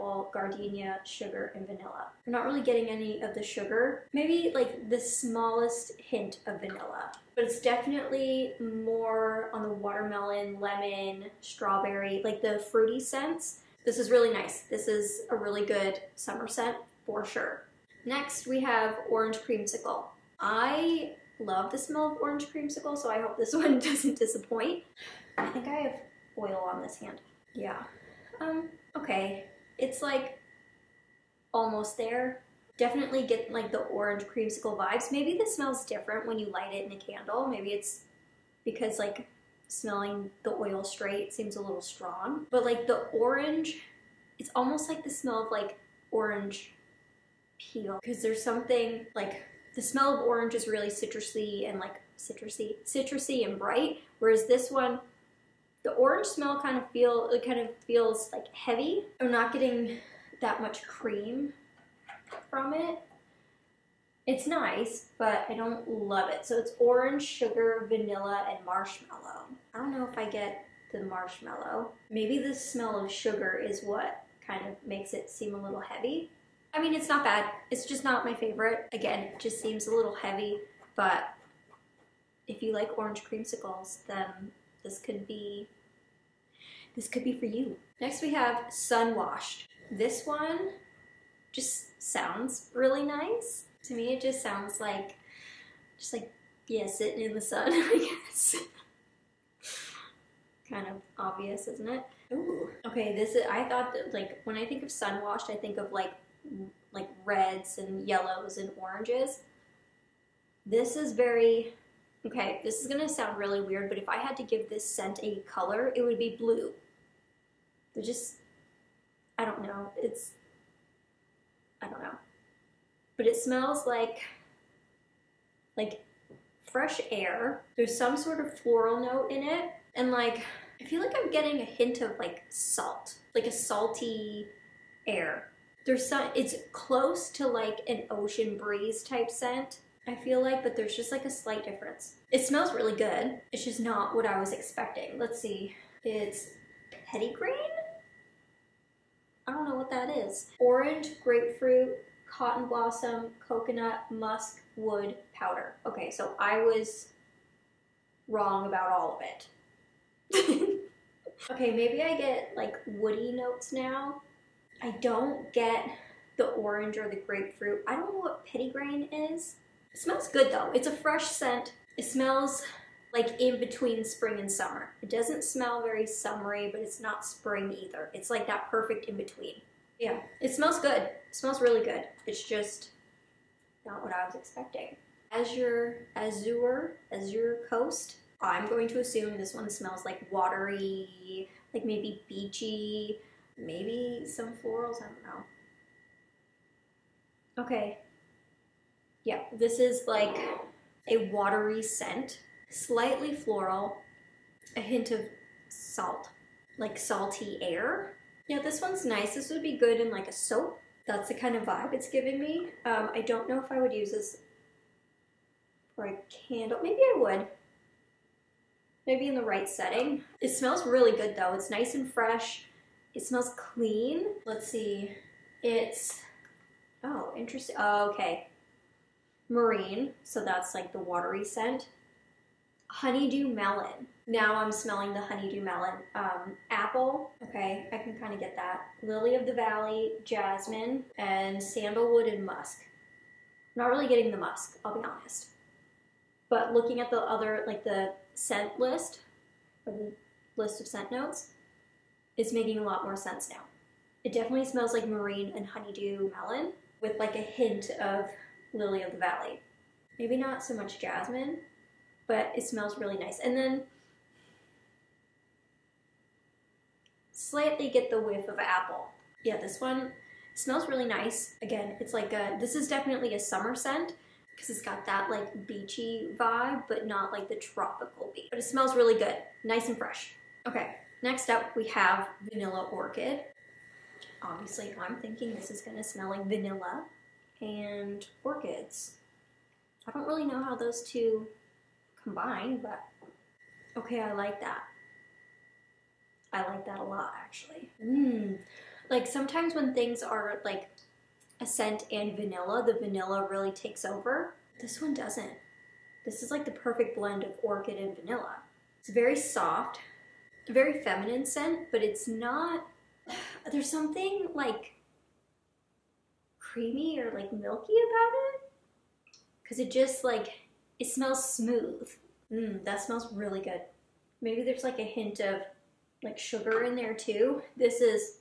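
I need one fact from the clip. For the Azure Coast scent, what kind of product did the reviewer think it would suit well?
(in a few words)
Soap.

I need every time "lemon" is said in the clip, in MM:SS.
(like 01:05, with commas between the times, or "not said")
00:10.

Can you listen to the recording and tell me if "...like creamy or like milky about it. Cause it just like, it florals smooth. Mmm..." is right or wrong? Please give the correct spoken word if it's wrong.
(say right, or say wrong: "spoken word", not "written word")
wrong: "smells", not "florals".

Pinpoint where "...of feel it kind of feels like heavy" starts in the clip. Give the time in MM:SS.
00:56.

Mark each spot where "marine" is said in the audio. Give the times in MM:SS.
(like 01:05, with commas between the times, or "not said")
03:49, 04:15.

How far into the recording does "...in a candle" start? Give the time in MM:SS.
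00:36.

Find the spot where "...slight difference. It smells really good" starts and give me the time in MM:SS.
02:21.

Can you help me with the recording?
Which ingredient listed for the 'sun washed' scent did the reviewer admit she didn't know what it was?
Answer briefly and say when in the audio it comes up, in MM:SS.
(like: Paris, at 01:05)
Petitgrain, at 02:48.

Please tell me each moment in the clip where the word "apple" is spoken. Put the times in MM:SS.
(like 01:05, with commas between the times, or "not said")
03:56, 04:28.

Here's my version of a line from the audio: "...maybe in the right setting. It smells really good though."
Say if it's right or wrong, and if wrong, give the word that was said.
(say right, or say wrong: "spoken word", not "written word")
right.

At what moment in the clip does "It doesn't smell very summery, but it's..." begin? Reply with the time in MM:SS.
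02:55.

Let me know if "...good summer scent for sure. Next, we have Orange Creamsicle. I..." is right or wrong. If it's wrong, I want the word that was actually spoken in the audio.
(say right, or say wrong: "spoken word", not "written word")
right.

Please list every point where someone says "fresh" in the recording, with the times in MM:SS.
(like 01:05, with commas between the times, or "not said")
02:06, 02:50, 03:42, 04:39.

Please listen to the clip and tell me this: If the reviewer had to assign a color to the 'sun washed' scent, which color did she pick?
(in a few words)
Blue.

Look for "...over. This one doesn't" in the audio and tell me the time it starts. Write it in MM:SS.
05:04.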